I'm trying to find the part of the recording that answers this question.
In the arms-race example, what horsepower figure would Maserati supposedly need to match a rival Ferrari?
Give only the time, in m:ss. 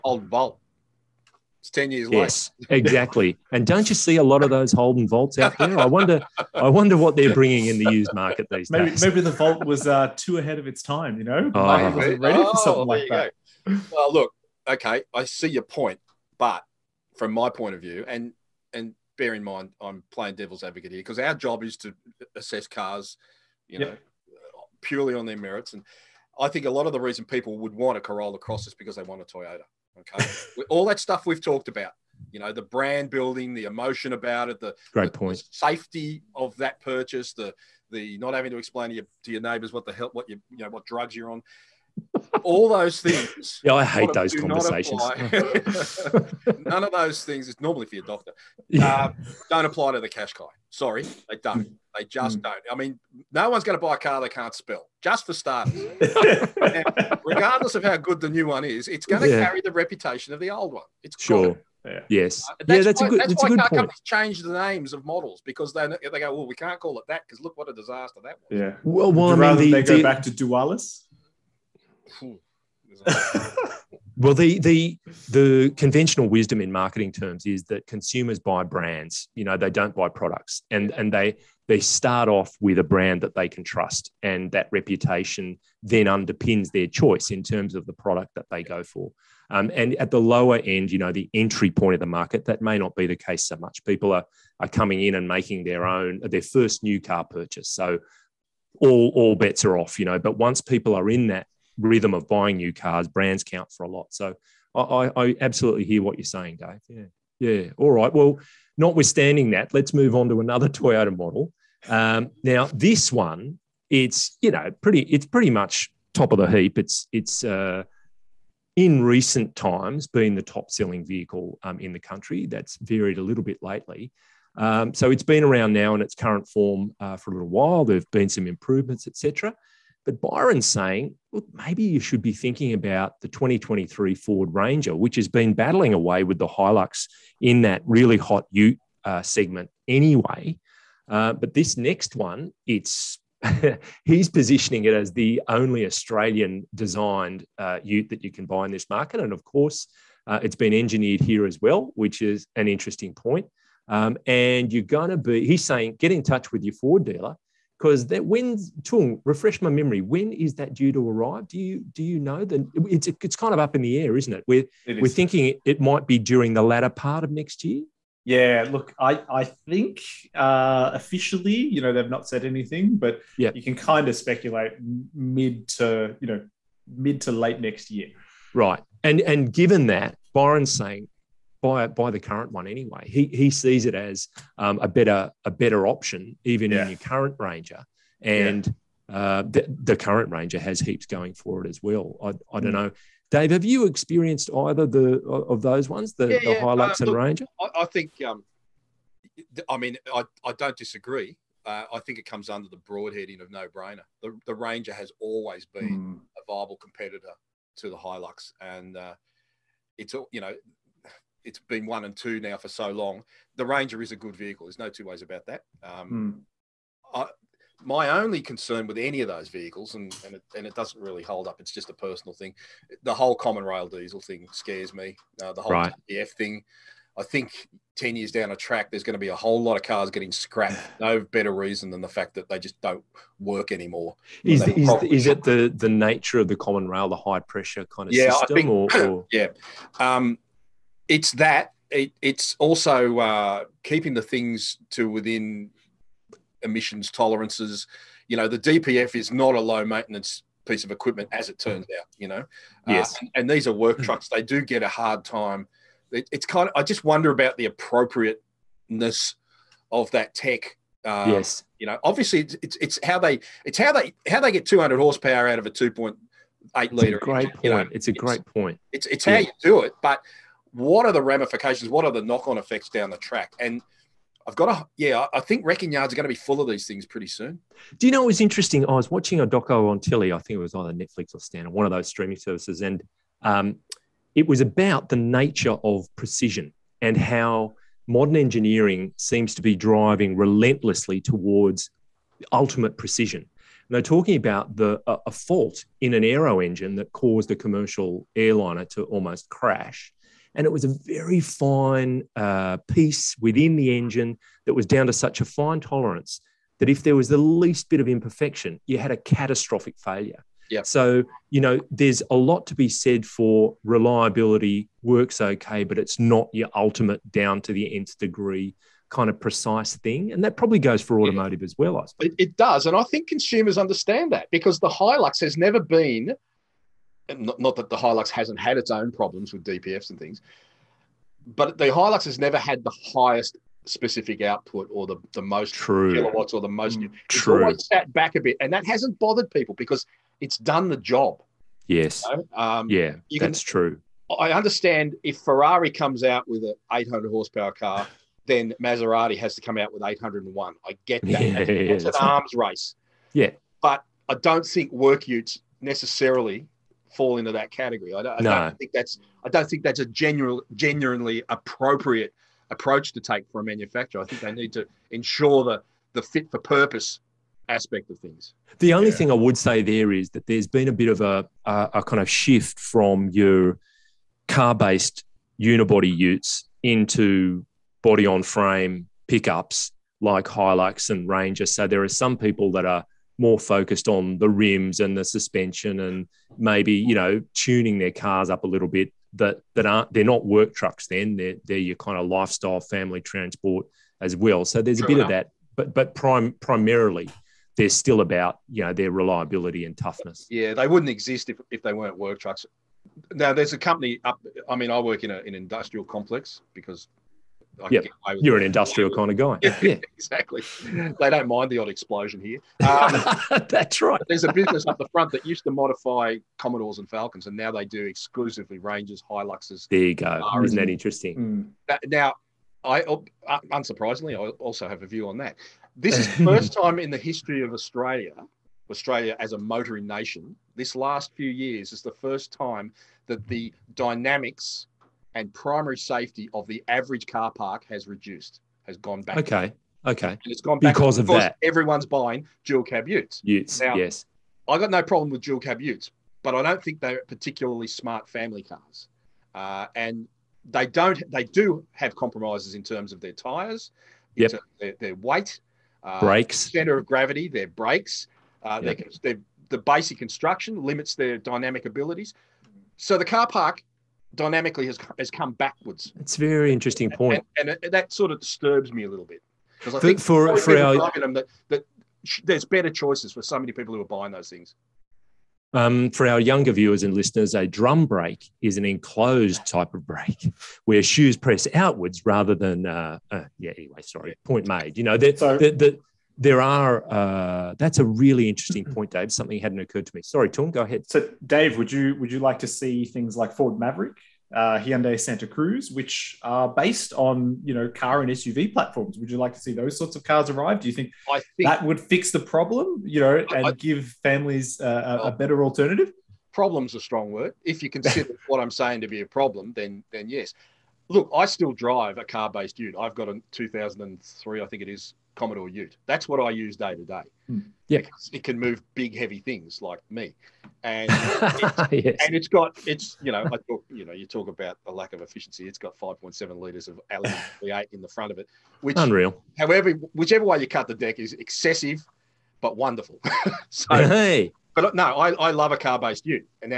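5:50.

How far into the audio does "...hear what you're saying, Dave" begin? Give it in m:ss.
1:45.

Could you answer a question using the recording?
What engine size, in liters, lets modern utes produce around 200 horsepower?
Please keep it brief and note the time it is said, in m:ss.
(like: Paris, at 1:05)
2.8 liters, at 4:25.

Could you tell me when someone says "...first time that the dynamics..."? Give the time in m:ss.
7:12.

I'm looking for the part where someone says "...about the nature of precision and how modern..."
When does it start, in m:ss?
4:44.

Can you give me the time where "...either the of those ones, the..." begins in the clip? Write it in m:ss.
3:14.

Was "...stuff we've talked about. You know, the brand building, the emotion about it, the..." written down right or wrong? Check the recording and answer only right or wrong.
right.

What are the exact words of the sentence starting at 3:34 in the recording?
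There's no two ways about that.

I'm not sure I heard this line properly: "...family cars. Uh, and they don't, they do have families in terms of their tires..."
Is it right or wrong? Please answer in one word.
wrong.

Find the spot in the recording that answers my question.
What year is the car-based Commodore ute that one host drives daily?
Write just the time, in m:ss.
8:33.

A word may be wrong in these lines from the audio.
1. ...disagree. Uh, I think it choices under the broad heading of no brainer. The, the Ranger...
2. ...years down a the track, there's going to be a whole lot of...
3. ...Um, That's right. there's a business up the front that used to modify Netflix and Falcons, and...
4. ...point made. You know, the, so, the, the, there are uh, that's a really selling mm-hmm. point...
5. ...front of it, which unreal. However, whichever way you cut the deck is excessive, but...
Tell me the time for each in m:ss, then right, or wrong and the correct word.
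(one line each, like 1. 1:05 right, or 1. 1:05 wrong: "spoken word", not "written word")
1. 3:20 wrong: "comes", not "choices"
2. 3:48 right
3. 6:52 wrong: "Commodores", not "Netflix"
4. 8:04 wrong: "interesting", not "selling"
5. 8:48 right.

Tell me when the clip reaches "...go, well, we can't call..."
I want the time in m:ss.
1:06.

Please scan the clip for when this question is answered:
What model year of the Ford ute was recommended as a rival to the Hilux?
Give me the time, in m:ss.
2:13.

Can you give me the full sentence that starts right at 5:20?
And that probably goes for automotive yeah.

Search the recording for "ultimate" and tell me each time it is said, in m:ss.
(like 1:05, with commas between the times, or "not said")
4:52, 5:16.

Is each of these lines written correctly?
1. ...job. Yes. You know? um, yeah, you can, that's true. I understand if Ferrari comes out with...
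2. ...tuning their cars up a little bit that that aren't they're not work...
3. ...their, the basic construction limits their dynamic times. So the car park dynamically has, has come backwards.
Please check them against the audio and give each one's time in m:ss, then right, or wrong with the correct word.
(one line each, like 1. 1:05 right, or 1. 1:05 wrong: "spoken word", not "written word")
1. 5:40 right
2. 6:27 right
3. 7:39 wrong: "abilities", not "times".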